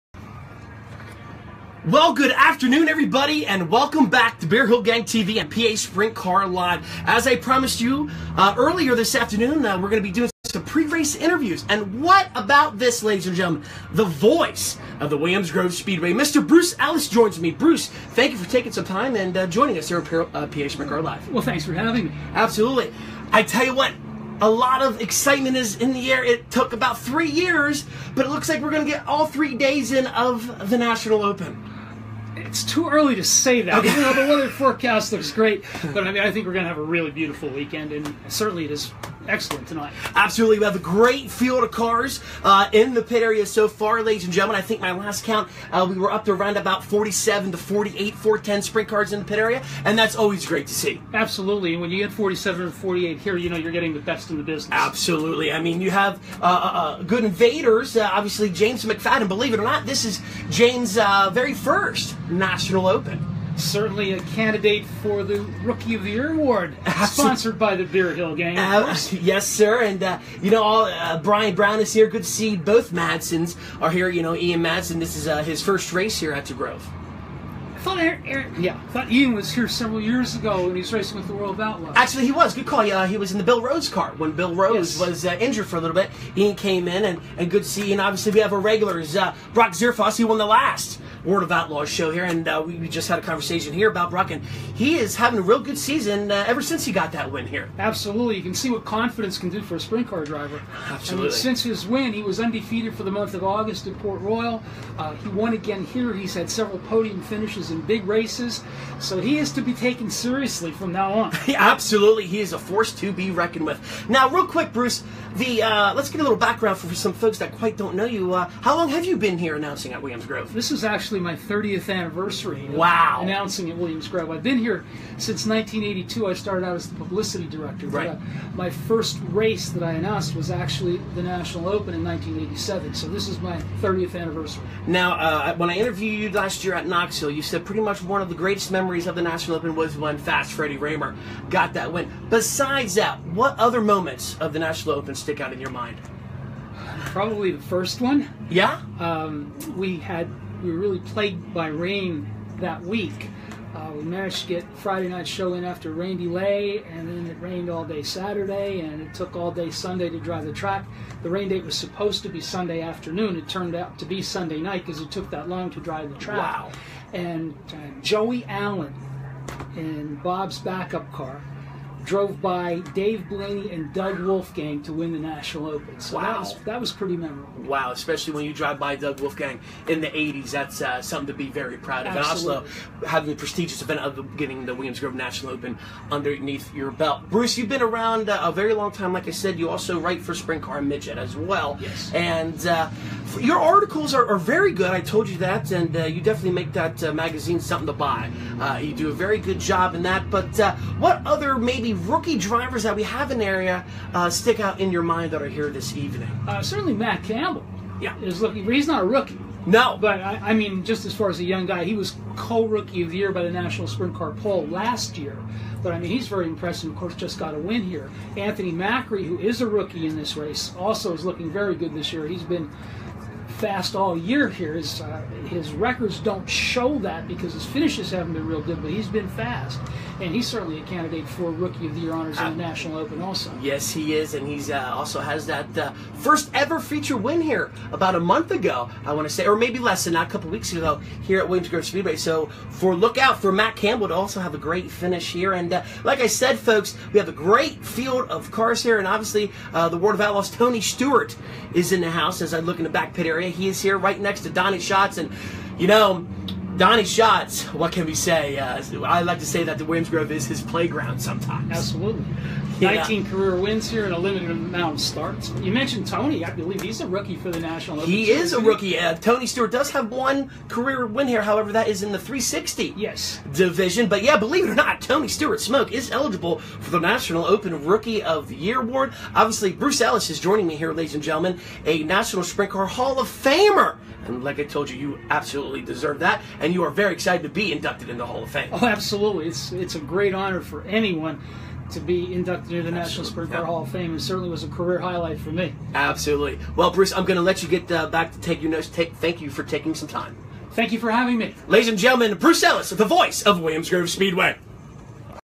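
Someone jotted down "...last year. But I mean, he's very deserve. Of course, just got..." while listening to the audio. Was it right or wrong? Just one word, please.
wrong.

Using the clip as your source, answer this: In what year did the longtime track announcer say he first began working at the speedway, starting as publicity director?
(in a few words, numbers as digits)
1982.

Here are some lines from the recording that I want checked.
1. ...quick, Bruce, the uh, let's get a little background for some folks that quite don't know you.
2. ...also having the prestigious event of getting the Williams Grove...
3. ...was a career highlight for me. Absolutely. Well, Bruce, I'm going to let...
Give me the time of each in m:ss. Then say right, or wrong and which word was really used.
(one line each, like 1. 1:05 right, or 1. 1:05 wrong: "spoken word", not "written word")
1. 1:54 right
2. 3:02 right
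3. 4:54 right.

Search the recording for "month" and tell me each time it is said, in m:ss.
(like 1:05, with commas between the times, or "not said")
1:43, 3:58.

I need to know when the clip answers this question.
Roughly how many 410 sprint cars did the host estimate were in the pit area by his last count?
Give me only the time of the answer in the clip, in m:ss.
0:46.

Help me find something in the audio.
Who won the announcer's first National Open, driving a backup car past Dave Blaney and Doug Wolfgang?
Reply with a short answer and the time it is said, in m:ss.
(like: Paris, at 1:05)
Joey Allen, at 2:48.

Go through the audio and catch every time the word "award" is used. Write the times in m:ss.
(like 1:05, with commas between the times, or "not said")
1:06, 4:38.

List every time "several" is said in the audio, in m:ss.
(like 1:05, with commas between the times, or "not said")
1:19, 1:46.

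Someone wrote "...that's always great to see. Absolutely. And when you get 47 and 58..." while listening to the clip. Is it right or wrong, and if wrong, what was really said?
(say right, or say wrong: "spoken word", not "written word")
wrong: "48", not "58".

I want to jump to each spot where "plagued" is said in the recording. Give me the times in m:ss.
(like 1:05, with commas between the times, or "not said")
2:30.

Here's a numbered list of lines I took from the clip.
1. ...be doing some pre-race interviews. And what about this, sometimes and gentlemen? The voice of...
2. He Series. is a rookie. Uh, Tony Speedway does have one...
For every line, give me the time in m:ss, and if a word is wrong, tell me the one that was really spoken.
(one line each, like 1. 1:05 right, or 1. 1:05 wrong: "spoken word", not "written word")
1. 0:10 wrong: "ladies", not "sometimes"
2. 4:28 wrong: "Stewart", not "Speedway".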